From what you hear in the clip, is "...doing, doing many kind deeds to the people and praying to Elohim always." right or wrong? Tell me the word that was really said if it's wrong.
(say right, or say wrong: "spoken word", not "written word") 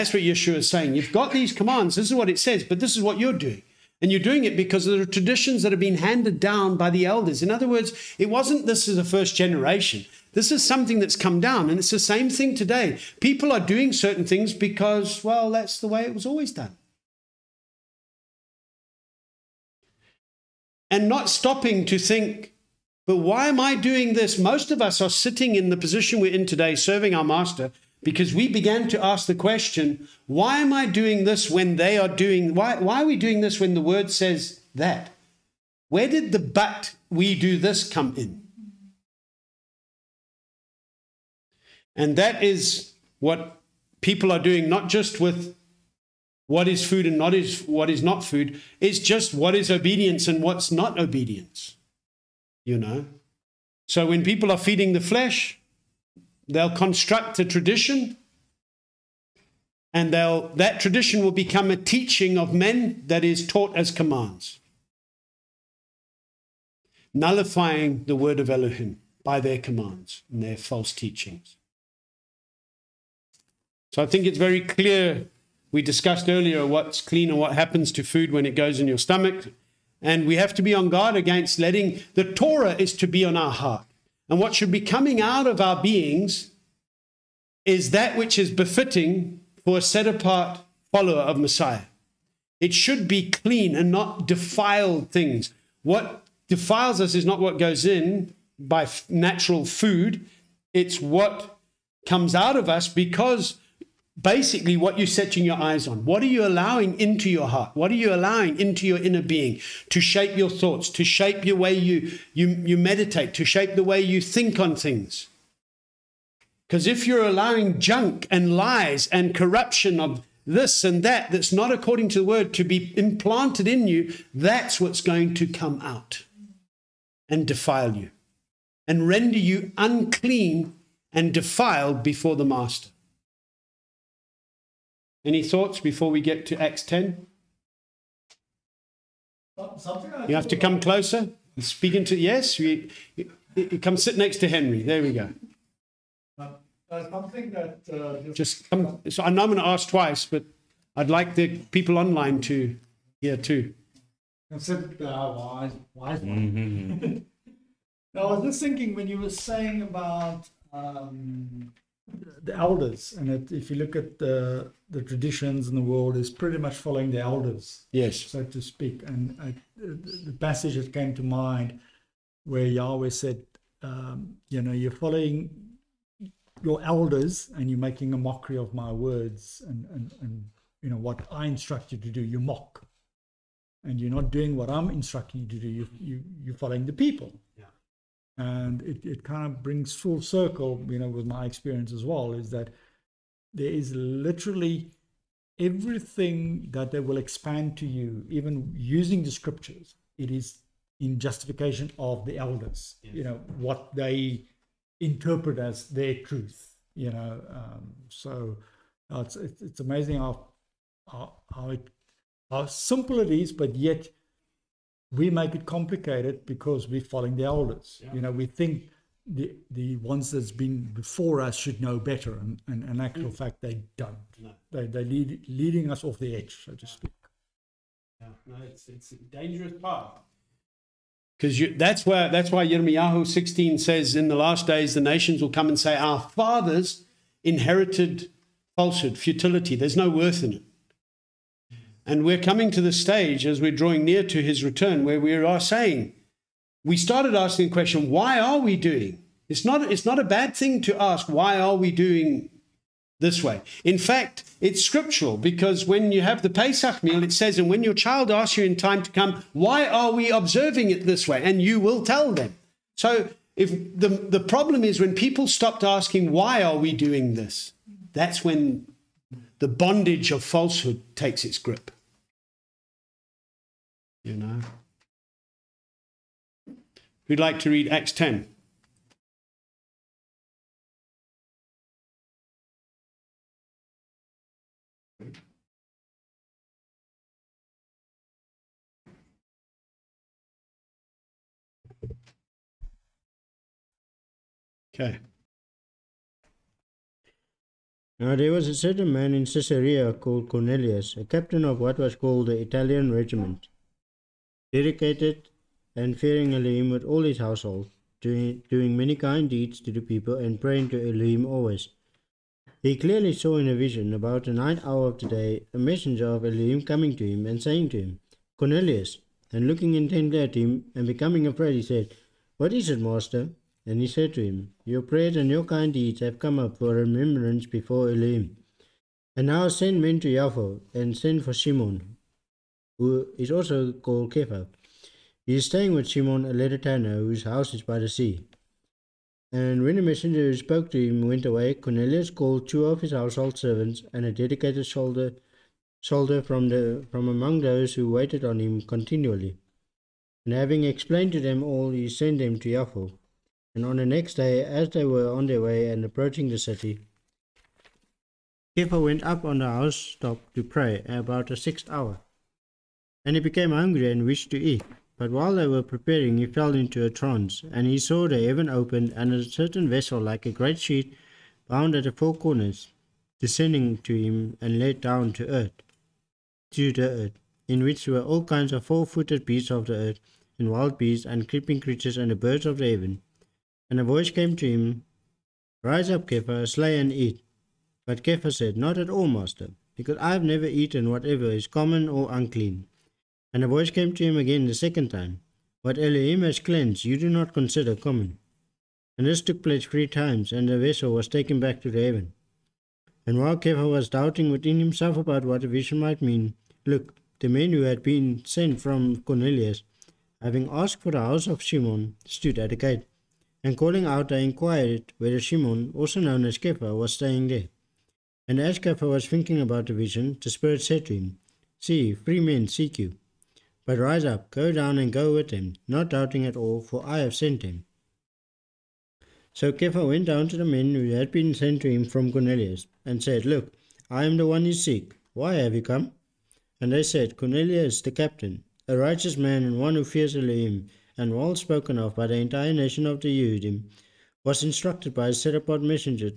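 right.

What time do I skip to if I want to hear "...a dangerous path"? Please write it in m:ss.
3:49.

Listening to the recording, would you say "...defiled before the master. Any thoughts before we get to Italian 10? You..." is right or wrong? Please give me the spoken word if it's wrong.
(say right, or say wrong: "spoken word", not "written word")
wrong: "Acts", not "Italian".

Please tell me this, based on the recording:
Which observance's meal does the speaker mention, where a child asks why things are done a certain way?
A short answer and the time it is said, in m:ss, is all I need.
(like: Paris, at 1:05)
Pesach, at 4:16.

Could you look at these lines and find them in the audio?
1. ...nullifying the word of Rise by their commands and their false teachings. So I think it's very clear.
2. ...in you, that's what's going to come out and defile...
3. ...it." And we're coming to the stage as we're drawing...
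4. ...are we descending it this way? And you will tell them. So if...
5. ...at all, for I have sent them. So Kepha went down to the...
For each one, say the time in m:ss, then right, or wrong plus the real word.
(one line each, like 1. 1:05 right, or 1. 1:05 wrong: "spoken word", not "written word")
1. 1:07 wrong: "Elohim", not "Rise"
2. 2:03 right
3. 4:00 right
4. 4:19 wrong: "observing", not "descending"
5. 7:06 right.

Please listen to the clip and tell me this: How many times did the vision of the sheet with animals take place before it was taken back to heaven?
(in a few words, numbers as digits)
3.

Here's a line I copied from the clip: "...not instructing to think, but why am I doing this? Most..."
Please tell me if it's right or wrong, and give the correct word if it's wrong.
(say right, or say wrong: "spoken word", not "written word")
wrong: "stopping", not "instructing".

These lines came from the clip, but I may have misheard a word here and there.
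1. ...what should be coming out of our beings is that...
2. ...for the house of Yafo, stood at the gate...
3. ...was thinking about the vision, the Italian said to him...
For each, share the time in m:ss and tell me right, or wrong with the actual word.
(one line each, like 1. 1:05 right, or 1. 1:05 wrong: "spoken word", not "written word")
1. 1:24 right
2. 6:51 wrong: "Simon", not "Yafo"
3. 6:59 wrong: "Spirit", not "Italian".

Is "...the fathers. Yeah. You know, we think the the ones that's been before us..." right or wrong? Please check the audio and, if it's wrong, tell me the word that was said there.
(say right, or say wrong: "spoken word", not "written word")
wrong: "elders", not "fathers".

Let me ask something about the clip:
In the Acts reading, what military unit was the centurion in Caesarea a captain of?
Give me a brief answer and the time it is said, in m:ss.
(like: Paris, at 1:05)
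Italian regiment, at 5:02.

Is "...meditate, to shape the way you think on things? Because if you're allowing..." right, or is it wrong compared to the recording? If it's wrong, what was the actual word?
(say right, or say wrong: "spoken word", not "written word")
right.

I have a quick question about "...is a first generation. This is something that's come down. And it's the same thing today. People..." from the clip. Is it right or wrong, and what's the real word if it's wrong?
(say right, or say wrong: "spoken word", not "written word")
right.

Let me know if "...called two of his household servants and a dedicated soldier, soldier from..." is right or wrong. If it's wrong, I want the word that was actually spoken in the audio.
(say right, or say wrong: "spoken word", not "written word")
right.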